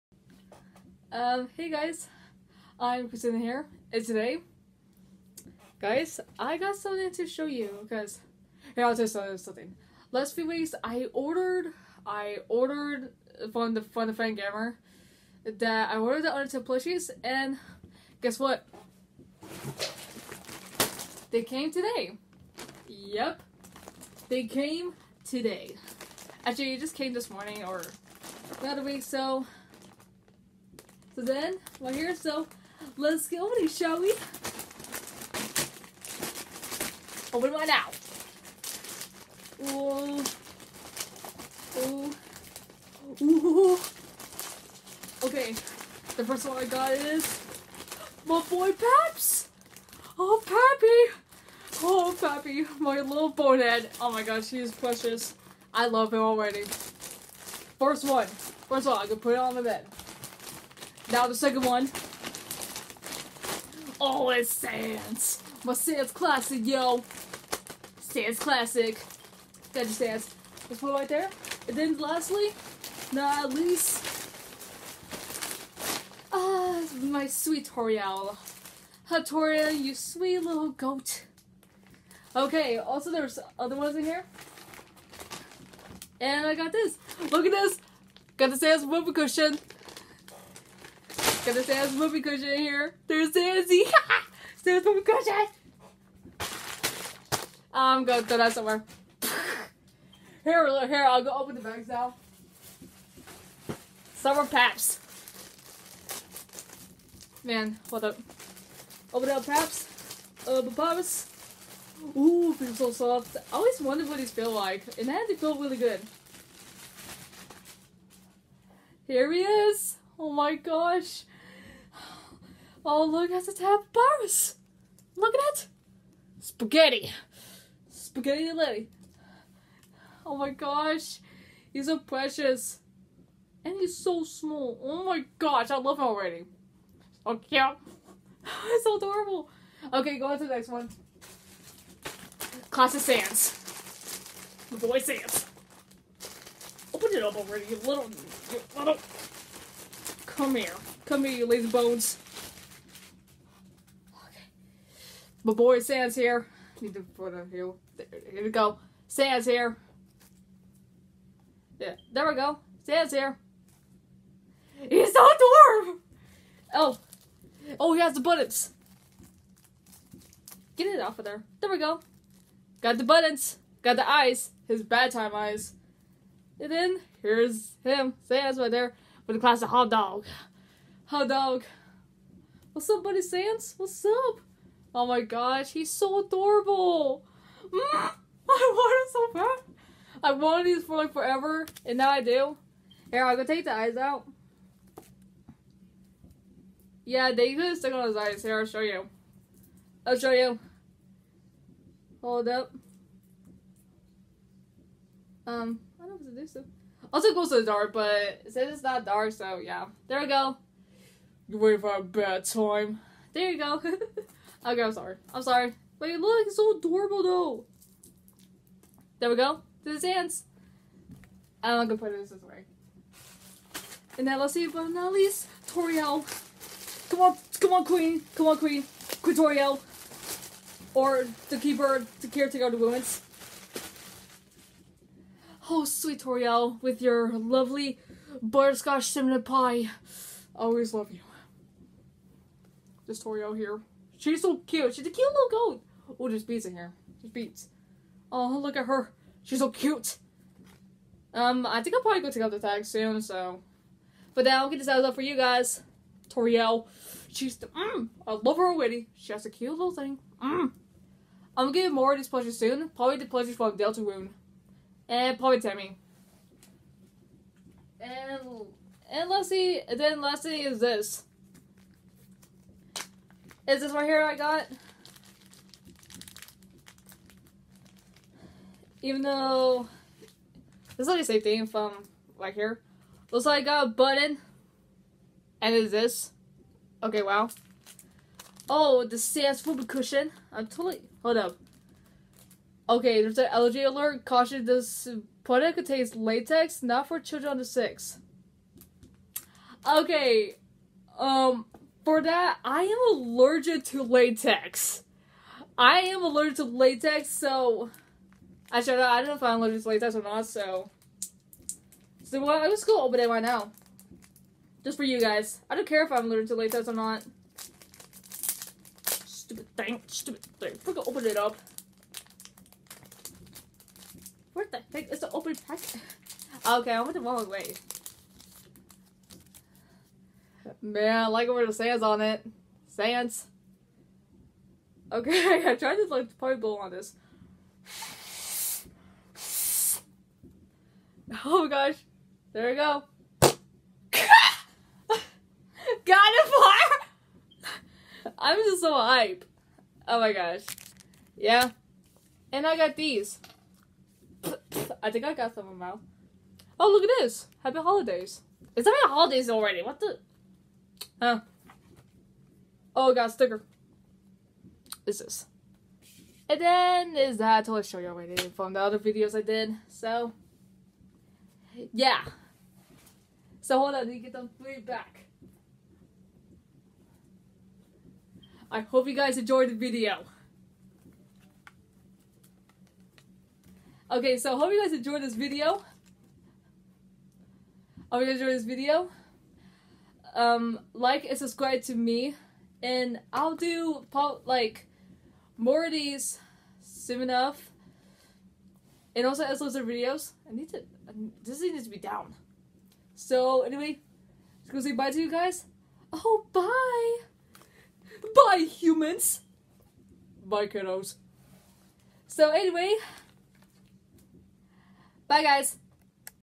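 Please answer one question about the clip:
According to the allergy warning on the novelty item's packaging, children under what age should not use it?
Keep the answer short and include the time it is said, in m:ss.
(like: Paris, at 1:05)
6, at 4:57.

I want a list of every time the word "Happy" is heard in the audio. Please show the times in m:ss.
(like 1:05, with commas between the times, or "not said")
5:57.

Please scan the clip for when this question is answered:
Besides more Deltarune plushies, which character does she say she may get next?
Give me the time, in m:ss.
4:25.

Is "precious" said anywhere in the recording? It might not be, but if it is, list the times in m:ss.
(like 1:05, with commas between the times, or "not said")
0:54, 2:11.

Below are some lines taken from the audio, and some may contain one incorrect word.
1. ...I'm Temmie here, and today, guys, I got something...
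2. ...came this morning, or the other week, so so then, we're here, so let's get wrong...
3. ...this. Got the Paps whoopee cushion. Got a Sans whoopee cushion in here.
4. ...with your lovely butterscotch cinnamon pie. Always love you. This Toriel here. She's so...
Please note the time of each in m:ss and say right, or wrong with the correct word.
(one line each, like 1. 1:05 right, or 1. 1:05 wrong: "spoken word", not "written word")
1. 0:02 wrong: "Kristina", not "Temmie"
2. 0:26 wrong: "opening", not "wrong"
3. 1:27 wrong: "Sans", not "Paps"
4. 3:56 right.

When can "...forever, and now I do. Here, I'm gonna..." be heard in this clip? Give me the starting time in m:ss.
3:11.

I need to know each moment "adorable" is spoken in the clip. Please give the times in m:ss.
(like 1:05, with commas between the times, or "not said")
2:18, 3:06, 3:36.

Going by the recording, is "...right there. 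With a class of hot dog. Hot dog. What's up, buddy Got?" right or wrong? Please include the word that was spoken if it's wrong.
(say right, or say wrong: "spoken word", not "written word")
wrong: "Sans", not "Got".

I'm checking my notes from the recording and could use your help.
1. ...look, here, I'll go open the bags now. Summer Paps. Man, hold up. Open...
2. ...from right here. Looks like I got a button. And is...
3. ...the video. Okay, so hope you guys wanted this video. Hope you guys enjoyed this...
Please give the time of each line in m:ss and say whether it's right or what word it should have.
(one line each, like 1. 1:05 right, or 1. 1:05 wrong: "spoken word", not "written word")
1. 1:40 right
2. 4:41 right
3. 6:19 wrong: "enjoyed", not "wanted".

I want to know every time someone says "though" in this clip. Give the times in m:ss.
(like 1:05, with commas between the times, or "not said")
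3:37, 4:39.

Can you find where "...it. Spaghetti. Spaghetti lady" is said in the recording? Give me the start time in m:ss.
2:05.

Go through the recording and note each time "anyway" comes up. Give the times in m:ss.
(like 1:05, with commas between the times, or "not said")
6:43, 6:52.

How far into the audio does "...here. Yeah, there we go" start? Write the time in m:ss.
2:39.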